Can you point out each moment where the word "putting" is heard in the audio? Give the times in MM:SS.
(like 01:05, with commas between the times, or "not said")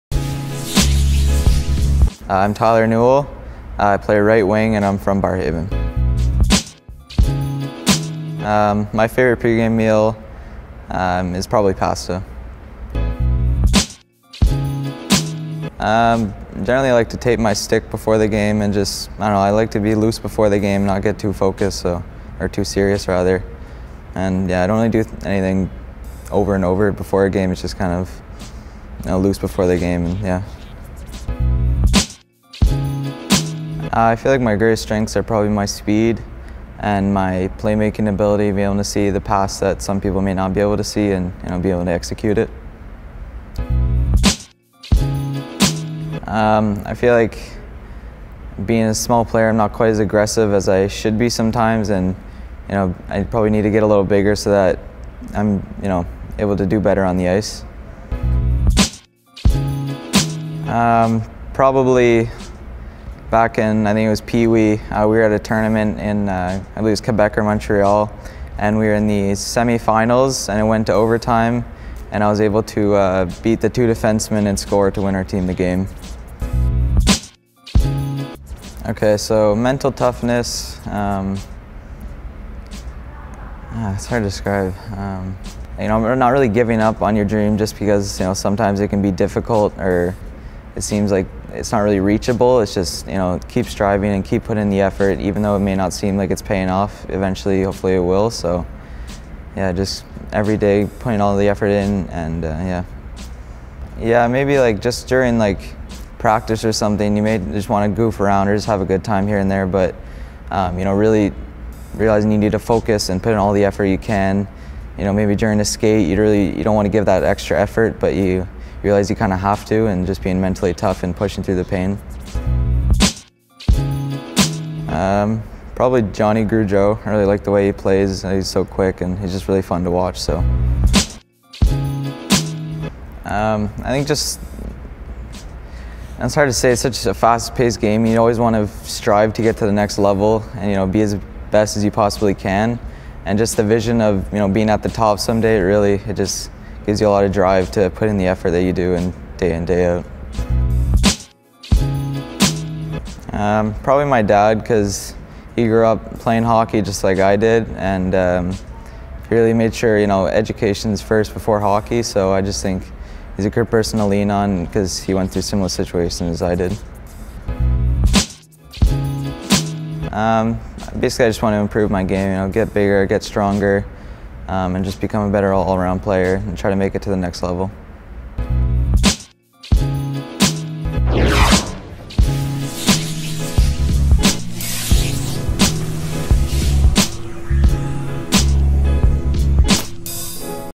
01:34, 01:40.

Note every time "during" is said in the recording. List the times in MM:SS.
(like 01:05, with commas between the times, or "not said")
01:45, 01:55.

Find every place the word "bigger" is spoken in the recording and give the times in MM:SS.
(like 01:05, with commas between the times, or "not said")
00:54, 02:52.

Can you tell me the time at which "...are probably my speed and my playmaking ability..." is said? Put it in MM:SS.
00:35.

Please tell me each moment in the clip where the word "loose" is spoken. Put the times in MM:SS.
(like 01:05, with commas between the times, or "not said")
00:19, 00:29.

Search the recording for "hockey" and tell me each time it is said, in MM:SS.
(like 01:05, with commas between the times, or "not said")
02:36, 02:41.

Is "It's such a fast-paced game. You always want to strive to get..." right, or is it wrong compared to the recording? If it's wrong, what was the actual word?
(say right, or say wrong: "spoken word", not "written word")
right.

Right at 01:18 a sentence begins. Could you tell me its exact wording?
Okay, so mental toughness, um, ah, it's hard to describe.